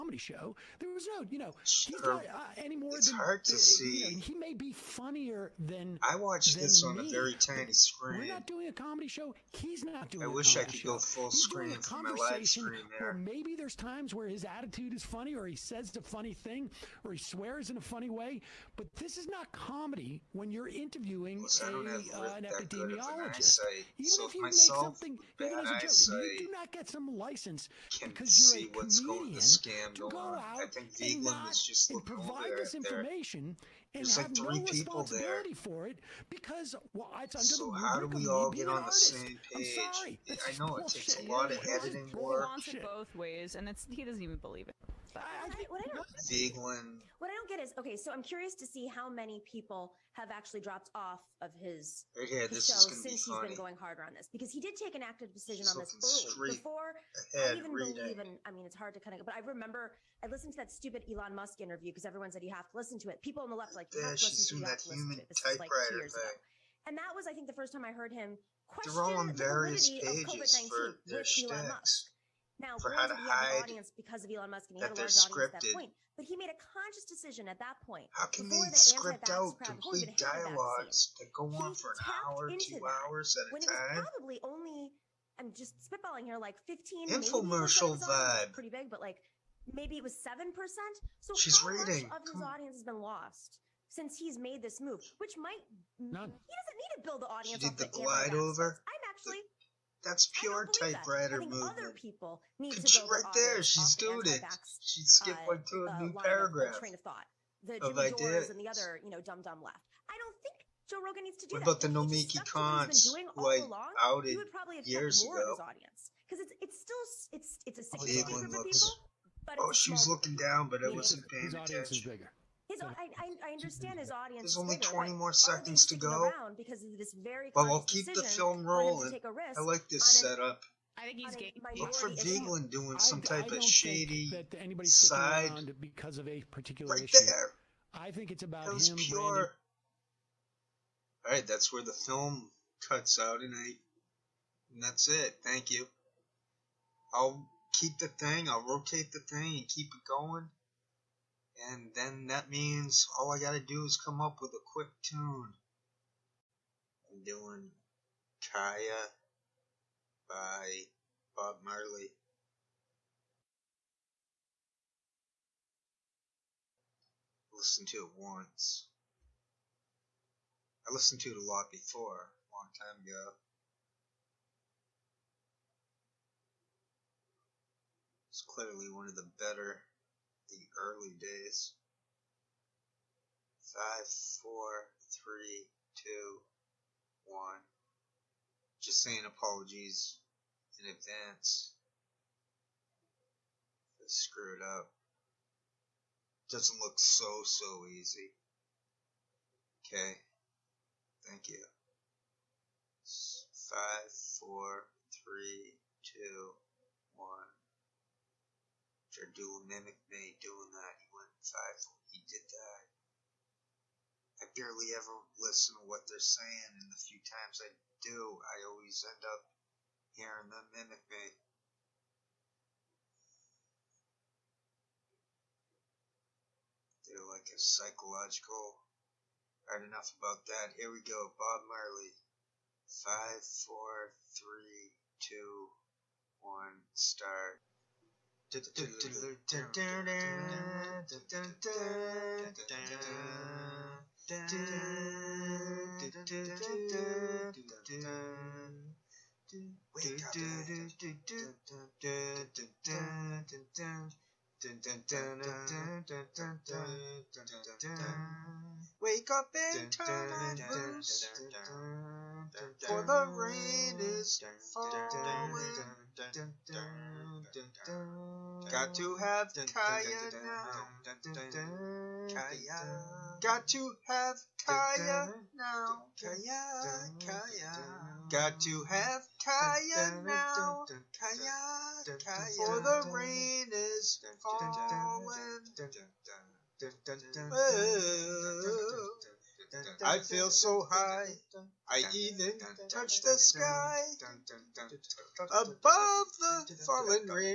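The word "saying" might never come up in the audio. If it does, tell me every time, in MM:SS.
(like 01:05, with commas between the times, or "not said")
03:09, 03:36.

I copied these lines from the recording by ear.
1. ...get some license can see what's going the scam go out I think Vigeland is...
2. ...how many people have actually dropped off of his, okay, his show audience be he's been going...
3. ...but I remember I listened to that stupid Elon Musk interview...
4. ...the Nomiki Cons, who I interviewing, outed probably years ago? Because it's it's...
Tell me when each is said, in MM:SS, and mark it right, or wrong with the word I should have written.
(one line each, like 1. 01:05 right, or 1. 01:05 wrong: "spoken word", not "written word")
1. 00:26 right
2. 00:48 wrong: "since", not "audience"
3. 00:59 right
4. 01:51 wrong: "along", not "interviewing".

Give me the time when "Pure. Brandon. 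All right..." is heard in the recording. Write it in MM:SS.
02:18.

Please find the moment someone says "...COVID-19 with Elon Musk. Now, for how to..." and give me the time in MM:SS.
01:10.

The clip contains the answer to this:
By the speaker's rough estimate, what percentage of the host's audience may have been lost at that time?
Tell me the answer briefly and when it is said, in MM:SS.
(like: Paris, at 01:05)
7%, at 01:30.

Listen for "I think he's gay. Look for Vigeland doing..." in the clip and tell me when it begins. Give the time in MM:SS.
02:10.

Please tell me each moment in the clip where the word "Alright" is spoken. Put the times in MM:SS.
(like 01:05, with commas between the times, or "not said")
03:49.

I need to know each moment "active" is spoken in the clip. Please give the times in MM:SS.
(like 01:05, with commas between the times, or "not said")
00:55.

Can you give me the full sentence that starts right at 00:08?
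We're not doing a comedy show.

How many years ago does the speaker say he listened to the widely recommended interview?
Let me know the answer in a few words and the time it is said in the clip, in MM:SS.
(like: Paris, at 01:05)
2, at 01:05.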